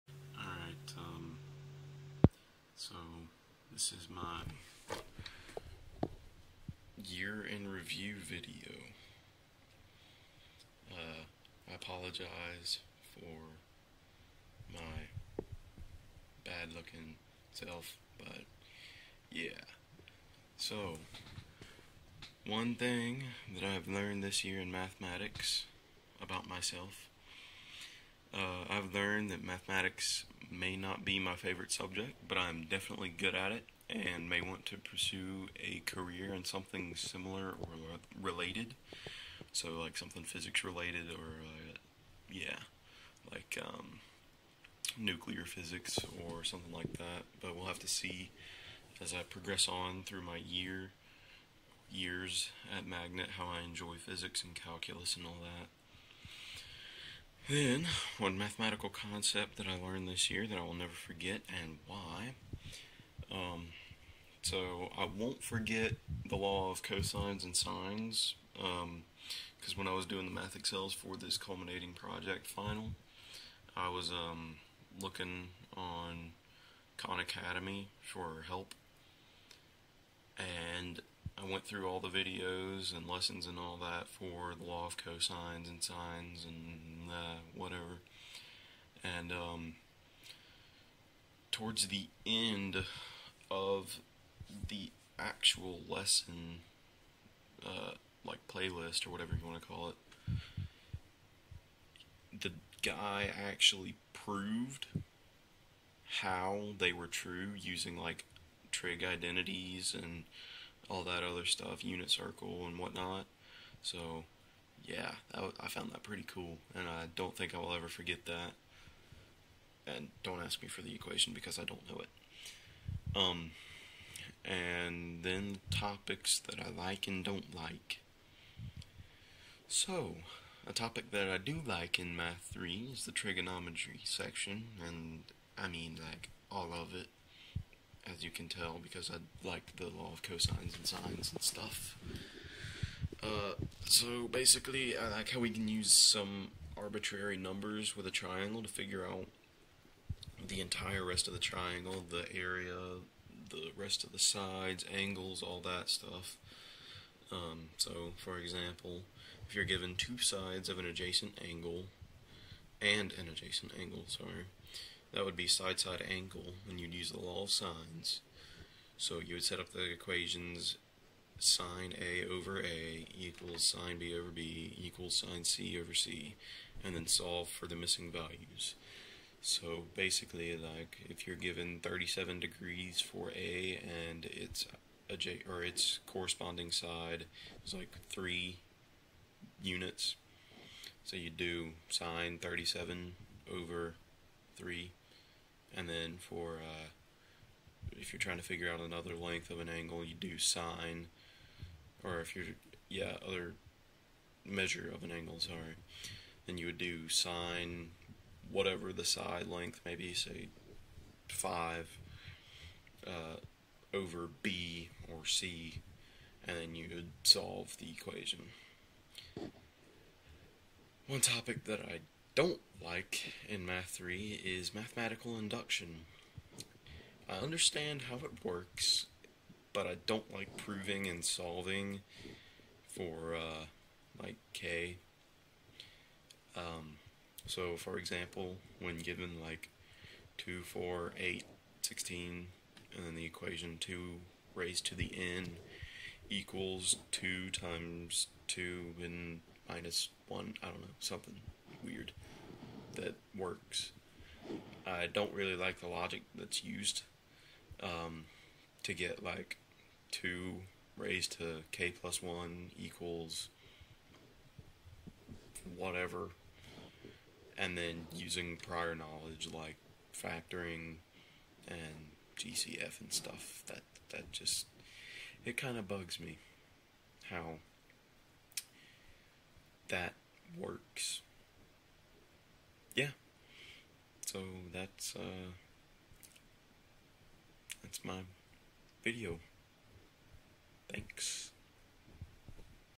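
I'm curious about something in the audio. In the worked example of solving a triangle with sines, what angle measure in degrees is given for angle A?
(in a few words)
37.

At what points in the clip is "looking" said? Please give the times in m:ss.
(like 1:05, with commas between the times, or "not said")
0:16, 1:15.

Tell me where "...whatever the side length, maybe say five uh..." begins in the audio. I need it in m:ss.
3:28.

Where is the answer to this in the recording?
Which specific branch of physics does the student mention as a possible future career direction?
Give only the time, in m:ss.
0:44.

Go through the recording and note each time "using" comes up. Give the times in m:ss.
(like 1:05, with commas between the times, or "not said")
1:47, 4:28.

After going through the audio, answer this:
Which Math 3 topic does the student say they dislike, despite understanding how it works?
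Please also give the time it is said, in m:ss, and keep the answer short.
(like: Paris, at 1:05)
Mathematical induction, at 3:44.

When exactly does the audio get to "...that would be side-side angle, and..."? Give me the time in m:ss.
2:45.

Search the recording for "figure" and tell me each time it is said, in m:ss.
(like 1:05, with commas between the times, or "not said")
2:28, 3:18.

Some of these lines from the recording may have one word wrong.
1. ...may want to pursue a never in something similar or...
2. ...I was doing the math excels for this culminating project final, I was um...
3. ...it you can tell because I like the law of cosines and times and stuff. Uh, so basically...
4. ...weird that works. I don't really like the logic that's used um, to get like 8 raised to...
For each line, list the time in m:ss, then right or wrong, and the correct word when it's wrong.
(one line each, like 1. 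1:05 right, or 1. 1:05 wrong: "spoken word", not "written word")
1. 0:34 wrong: "career", not "never"
2. 1:09 right
3. 2:16 wrong: "sines", not "times"
4. 4:11 wrong: "2", not "8".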